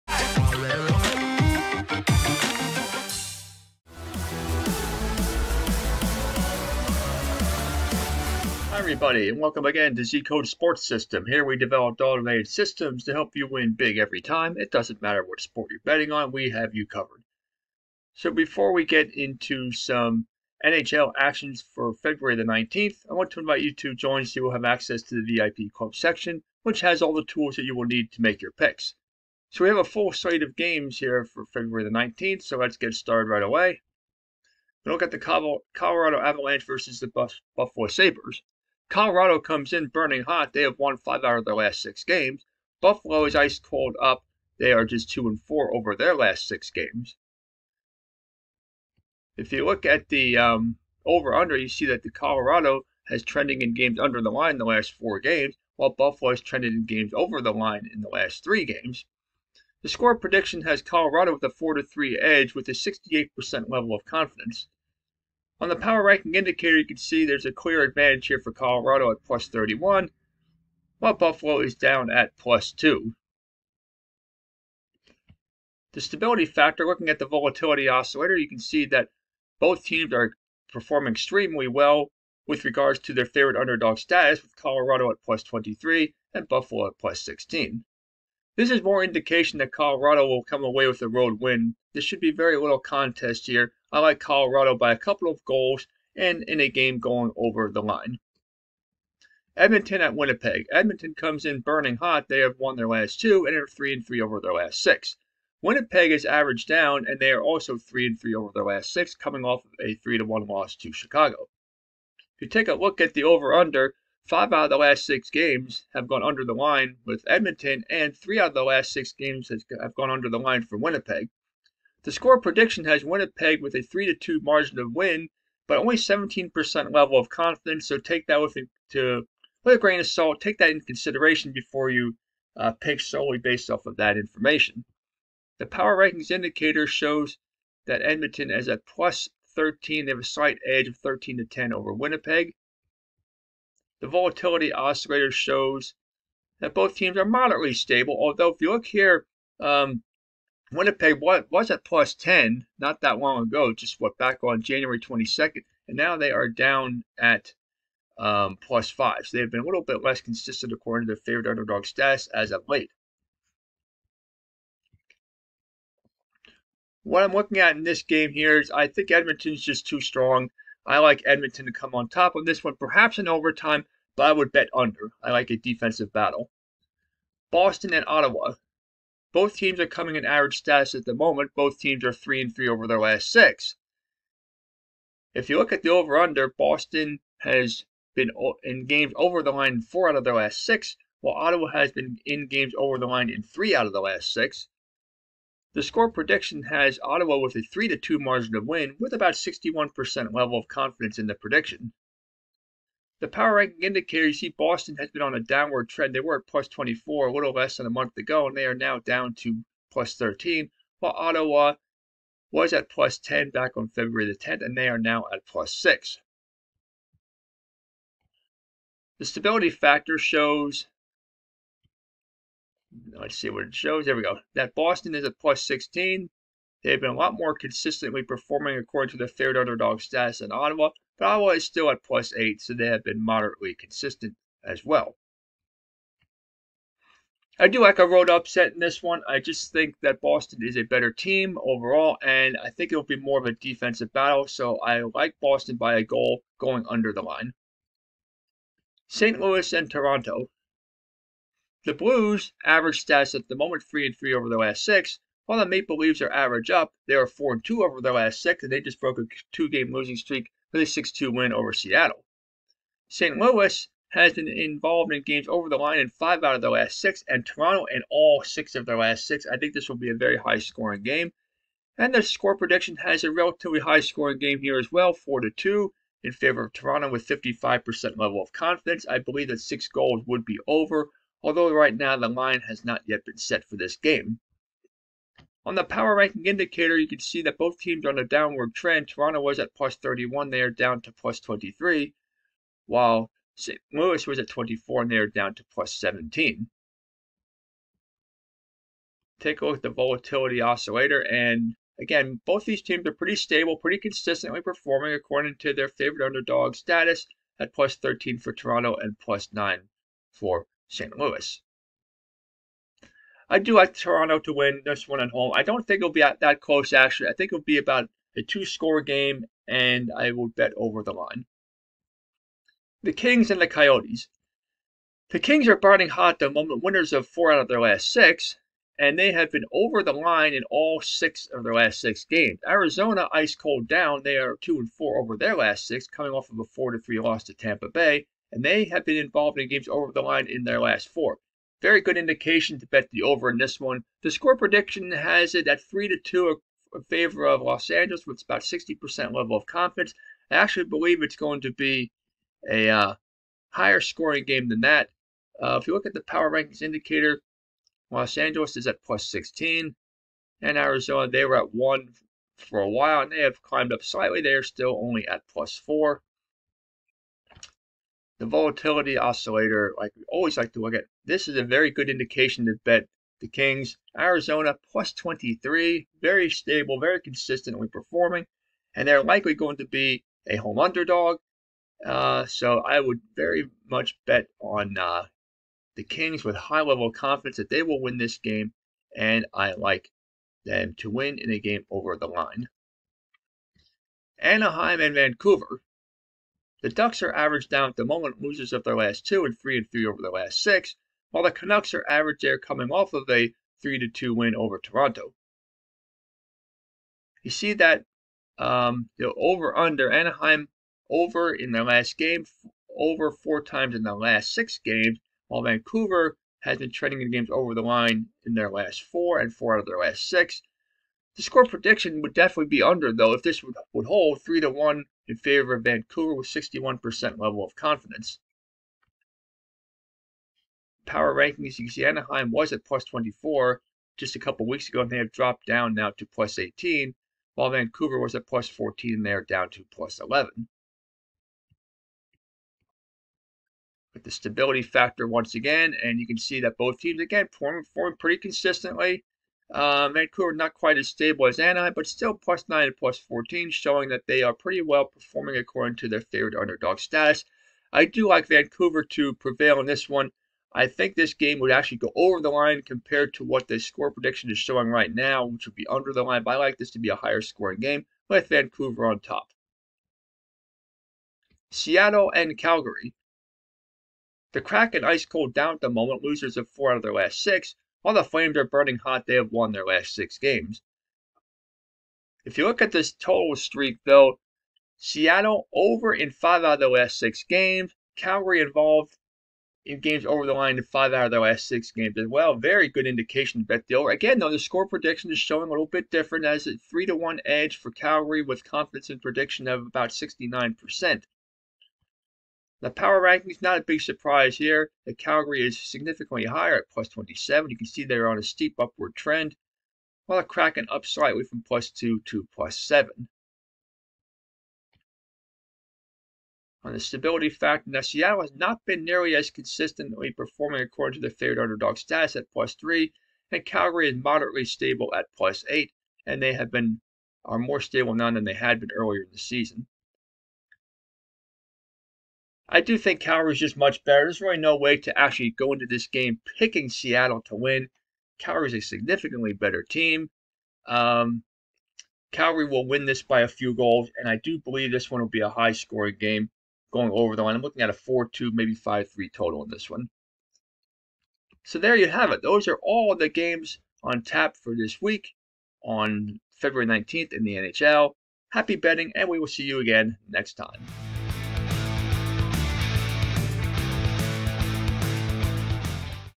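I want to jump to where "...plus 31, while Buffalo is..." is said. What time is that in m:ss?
1:09.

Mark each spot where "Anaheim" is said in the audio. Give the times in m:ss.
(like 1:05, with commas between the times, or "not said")
6:34, 6:50, 7:12, 7:31.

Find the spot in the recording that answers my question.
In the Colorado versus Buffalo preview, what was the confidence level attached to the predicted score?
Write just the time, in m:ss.
1:02.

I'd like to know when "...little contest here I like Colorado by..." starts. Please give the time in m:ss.
1:32.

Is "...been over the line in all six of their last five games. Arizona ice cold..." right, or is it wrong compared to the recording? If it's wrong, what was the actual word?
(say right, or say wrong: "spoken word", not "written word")
wrong: "six", not "five".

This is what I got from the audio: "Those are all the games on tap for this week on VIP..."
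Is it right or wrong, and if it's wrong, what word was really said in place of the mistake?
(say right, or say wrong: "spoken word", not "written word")
wrong: "February", not "VIP".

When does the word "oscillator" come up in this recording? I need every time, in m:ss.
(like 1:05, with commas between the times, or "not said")
1:17, 2:24, 5:00, 6:09.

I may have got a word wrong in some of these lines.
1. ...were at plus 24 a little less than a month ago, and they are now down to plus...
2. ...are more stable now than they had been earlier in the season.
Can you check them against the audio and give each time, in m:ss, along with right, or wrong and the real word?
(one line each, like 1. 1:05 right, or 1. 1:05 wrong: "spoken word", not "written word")
1. 3:26 right
2. 8:47 right.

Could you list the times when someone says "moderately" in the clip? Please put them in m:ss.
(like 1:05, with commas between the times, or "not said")
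2:27, 3:53, 8:44.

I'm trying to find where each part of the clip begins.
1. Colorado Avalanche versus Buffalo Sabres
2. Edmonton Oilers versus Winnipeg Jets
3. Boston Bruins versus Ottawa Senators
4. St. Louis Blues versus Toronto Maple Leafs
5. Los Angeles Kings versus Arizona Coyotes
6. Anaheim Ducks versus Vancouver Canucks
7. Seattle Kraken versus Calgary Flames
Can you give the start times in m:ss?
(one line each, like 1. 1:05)
1. 0:40
2. 1:40
3. 3:00
4. 4:10
5. 5:20
6. 6:40
7. 7:50.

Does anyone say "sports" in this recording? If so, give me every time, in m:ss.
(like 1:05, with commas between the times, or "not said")
0:10, 0:15.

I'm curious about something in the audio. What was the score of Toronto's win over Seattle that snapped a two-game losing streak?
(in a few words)
6-2.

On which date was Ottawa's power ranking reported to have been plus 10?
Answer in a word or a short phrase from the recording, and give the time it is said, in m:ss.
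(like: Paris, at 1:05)
February 10th, at 3:33.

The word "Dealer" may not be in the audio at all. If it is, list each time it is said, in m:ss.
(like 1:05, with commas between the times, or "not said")
8:13.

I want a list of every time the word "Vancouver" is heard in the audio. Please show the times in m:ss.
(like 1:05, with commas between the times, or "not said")
6:35, 6:55, 7:05, 7:17, 7:30, 7:38, 7:48.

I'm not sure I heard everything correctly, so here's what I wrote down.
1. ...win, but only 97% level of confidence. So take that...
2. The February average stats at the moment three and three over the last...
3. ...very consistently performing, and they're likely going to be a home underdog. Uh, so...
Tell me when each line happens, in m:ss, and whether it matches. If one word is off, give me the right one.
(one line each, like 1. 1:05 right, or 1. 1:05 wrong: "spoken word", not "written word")
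1. 2:04 wrong: "17", not "97"
2. 4:11 wrong: "Blues", not "February"
3. 6:16 right.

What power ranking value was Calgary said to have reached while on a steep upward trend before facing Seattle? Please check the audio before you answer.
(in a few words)
plus 27.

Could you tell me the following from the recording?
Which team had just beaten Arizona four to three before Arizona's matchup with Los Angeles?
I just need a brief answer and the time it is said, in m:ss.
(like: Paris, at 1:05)
Tampa Bay, at 5:37.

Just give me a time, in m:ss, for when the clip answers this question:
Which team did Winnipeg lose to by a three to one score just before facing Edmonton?
1:50.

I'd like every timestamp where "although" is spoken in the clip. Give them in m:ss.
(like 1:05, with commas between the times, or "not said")
2:28, 4:41.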